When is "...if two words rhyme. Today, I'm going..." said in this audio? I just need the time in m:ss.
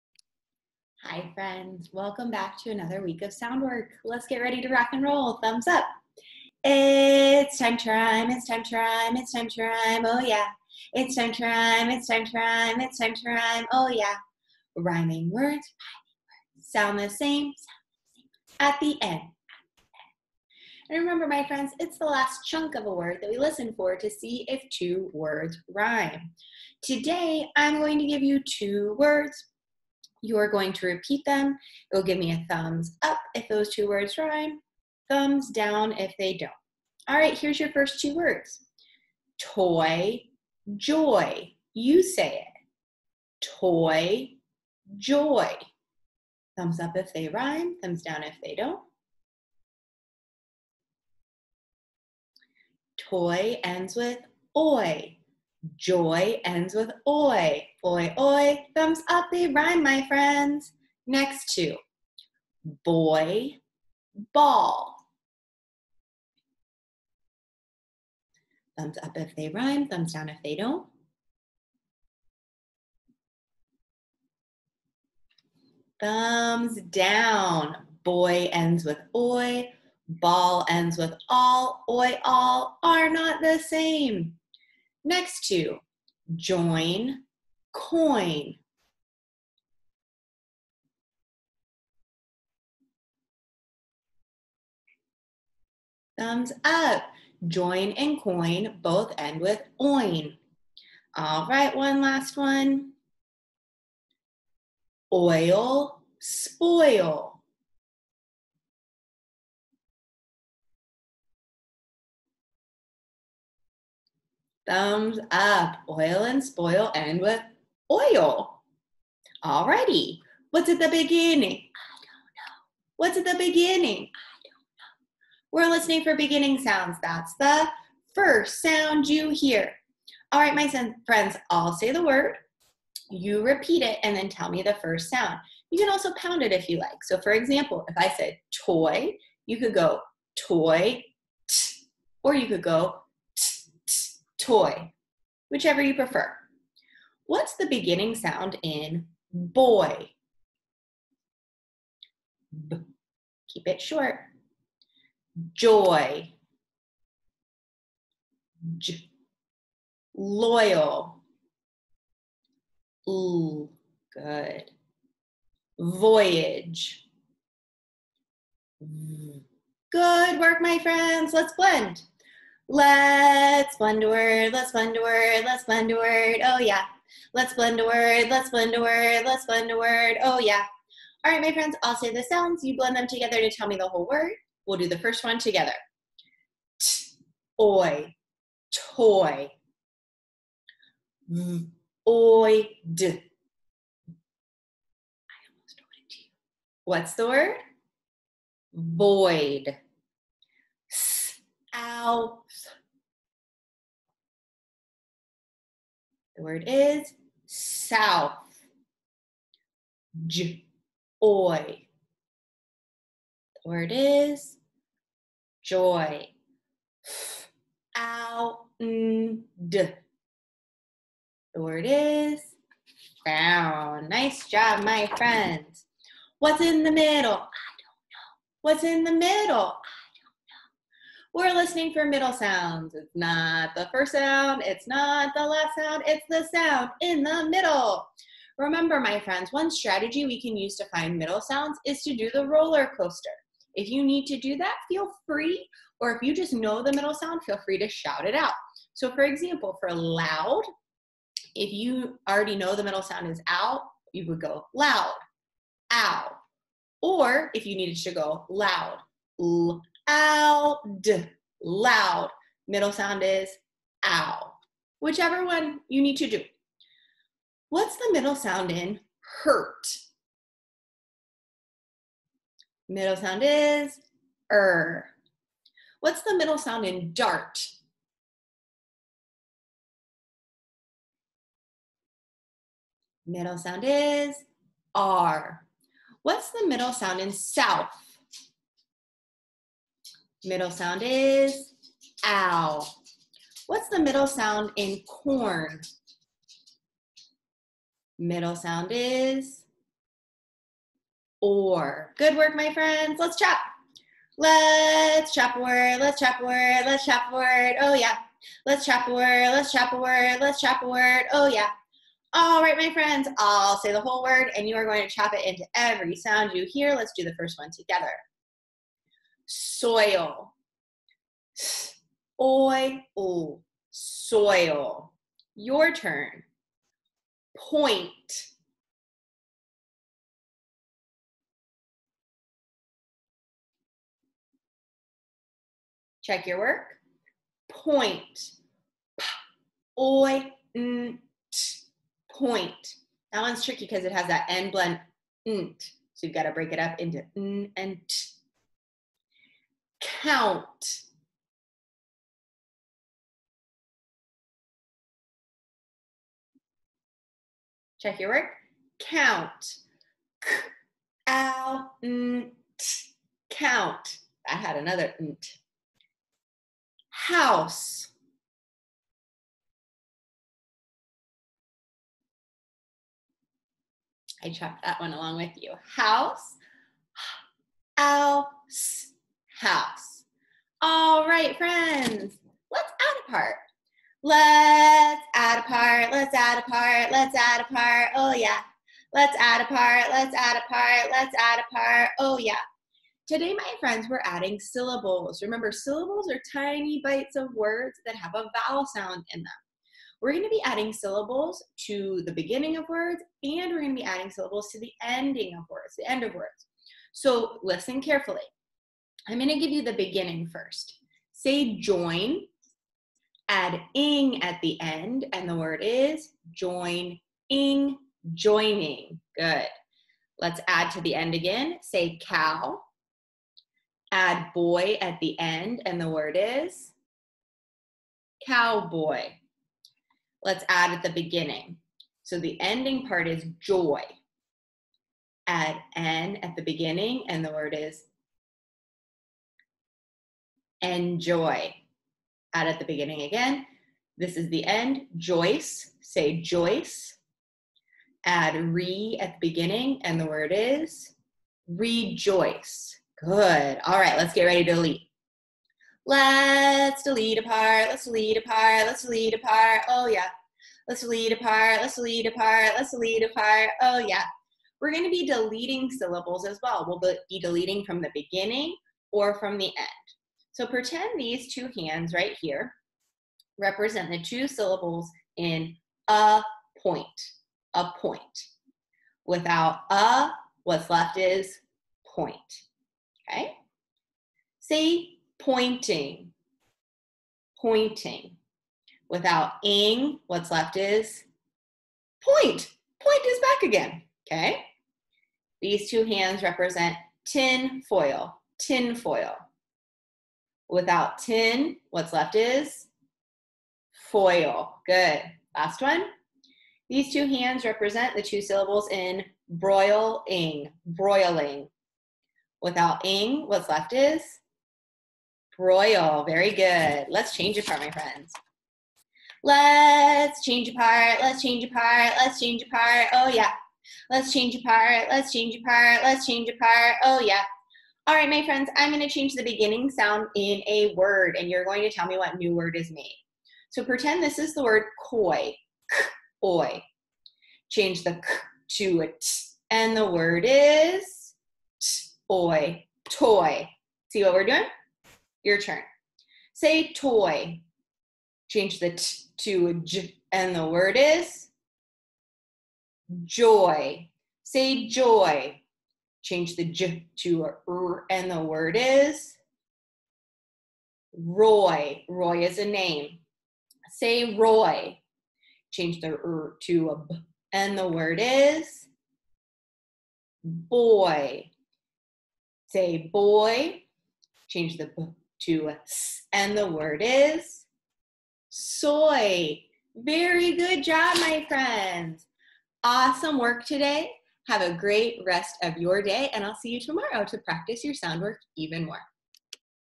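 0:24.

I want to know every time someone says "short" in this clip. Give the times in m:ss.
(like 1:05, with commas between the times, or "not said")
2:33.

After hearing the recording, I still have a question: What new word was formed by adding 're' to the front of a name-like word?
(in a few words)
rejoice.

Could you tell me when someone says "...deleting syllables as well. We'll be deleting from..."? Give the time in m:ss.
7:45.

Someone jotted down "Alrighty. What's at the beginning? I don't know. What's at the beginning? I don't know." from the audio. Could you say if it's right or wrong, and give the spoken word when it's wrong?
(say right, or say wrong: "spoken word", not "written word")
right.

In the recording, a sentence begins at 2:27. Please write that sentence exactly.
What's the beginning sound in boy?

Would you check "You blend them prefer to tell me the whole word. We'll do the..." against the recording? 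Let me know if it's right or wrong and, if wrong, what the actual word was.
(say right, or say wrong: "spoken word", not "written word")
wrong: "together", not "prefer".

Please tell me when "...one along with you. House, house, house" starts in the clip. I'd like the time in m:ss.
6:14.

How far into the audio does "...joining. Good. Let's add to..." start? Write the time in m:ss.
6:58.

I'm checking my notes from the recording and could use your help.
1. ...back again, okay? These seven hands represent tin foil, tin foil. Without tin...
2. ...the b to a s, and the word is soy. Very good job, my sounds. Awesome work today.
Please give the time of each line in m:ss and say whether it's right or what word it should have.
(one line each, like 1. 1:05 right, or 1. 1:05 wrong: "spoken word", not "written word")
1. 8:13 wrong: "two", not "seven"
2. 9:34 wrong: "friends", not "sounds".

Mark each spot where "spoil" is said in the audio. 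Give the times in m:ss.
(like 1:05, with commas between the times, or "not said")
1:46, 1:56.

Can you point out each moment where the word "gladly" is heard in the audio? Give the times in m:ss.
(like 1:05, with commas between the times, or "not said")
not said.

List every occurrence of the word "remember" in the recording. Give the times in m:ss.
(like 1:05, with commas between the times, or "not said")
0:20, 3:58, 6:35.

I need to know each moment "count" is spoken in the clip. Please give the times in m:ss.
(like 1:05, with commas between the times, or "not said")
5:50, 5:58, 6:03.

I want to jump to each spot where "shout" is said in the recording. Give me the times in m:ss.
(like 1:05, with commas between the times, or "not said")
4:07.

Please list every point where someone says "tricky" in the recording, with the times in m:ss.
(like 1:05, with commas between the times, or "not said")
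5:43.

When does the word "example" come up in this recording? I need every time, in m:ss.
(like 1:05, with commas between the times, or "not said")
2:17, 4:09.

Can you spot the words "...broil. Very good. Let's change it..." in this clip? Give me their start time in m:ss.
8:35.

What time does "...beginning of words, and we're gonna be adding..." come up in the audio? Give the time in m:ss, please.
6:42.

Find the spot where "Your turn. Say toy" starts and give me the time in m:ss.
9:05.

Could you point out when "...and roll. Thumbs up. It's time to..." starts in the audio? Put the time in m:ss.
0:04.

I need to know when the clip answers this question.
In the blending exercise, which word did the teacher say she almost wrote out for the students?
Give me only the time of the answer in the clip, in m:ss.
3:18.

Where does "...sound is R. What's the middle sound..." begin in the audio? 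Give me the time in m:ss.
4:43.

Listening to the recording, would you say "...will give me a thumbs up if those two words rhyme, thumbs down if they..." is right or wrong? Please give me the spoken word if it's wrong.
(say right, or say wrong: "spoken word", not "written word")
right.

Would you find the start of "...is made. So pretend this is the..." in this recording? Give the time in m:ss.
8:52.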